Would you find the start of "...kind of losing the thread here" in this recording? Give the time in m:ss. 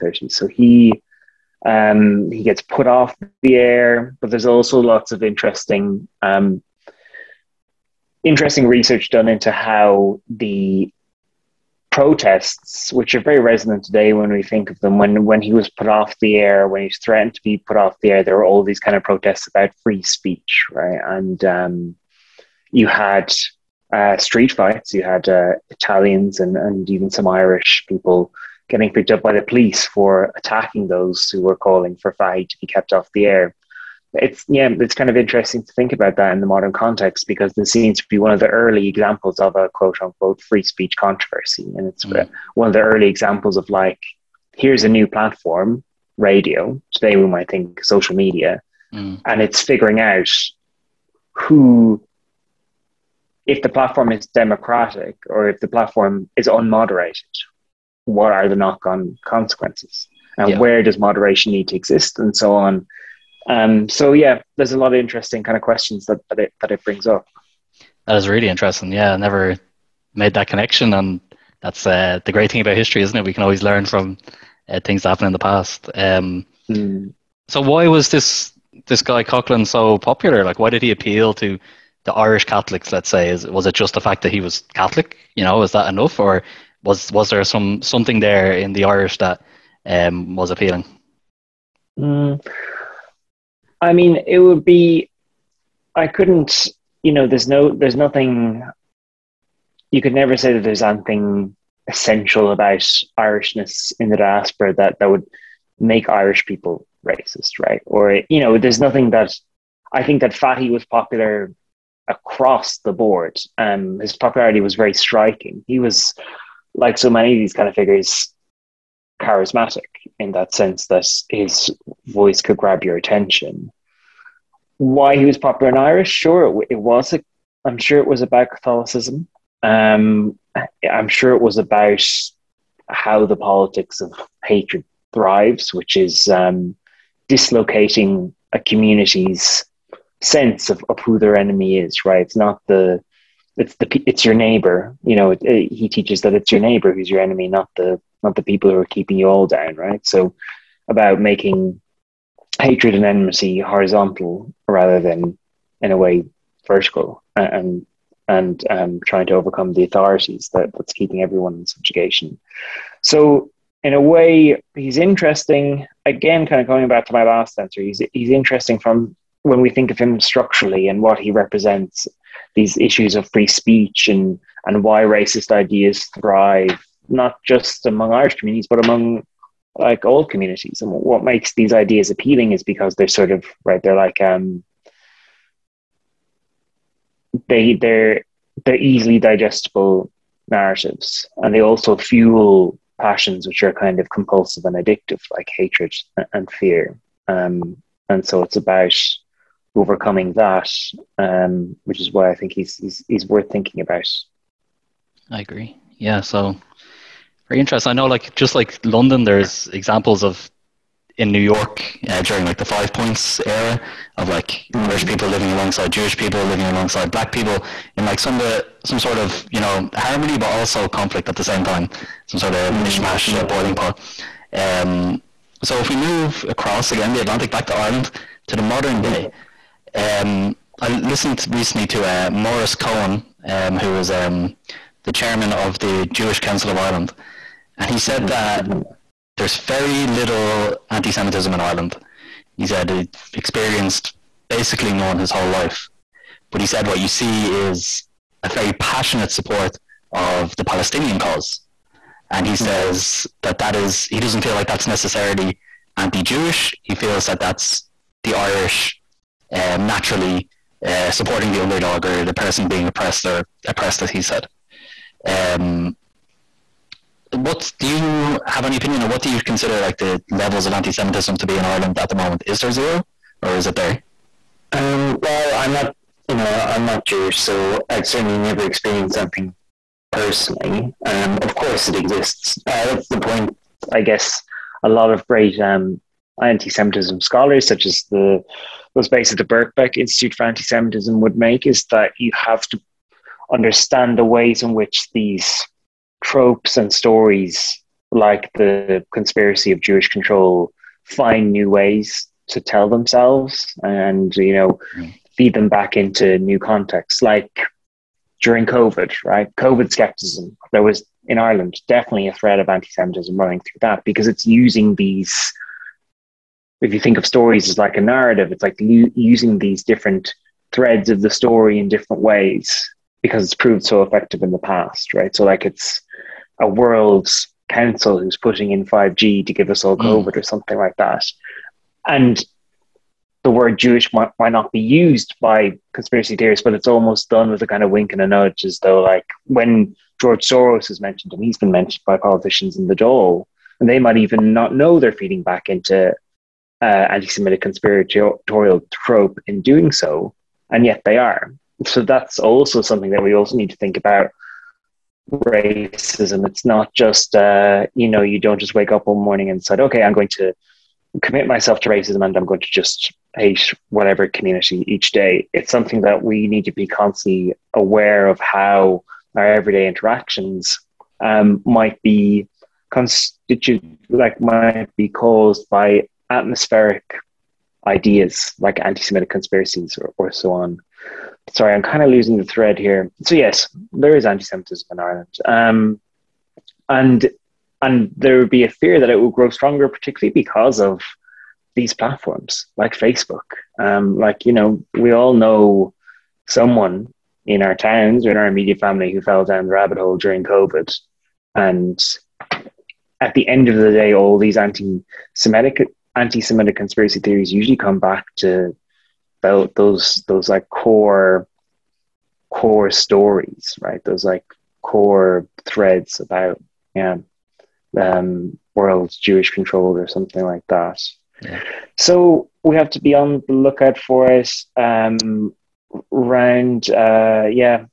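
6:21.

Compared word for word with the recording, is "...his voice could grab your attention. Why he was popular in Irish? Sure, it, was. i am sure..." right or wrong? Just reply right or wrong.
right.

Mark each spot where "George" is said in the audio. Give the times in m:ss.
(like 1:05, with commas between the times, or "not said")
5:40.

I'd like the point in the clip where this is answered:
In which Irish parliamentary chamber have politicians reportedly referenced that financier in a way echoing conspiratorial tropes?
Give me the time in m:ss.
5:42.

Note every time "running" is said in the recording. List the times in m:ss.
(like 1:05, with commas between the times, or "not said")
5:13.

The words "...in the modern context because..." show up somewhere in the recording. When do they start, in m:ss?
0:36.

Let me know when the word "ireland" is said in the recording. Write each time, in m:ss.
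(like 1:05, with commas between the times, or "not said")
3:47, 3:56, 4:01, 4:31, 5:11, 6:24.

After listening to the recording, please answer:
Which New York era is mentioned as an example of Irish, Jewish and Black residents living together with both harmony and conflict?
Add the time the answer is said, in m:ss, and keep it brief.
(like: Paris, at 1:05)
Five Points, at 3:32.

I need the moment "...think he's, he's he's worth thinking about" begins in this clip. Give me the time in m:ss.
3:22.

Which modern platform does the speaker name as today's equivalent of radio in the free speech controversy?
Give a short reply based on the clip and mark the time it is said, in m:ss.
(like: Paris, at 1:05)
Social media, at 0:47.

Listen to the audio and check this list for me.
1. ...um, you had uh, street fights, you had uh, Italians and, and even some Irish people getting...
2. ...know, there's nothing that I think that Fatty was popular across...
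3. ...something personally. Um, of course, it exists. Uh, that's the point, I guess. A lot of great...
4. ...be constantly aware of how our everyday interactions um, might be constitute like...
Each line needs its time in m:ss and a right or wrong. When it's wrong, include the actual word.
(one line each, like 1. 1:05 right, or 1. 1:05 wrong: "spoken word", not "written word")
1. 0:21 right
2. 1:48 right
3. 4:39 right
4. 6:06 right.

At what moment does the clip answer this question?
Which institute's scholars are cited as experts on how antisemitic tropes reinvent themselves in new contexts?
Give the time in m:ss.
4:49.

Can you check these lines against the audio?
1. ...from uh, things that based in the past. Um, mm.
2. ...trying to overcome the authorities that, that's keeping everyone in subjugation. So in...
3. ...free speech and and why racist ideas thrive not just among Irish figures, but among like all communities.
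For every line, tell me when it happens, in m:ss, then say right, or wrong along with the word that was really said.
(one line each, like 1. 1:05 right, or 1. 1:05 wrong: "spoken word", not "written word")
1. 1:13 wrong: "happened", not "based"
2. 2:39 right
3. 2:53 wrong: "communities", not "figures".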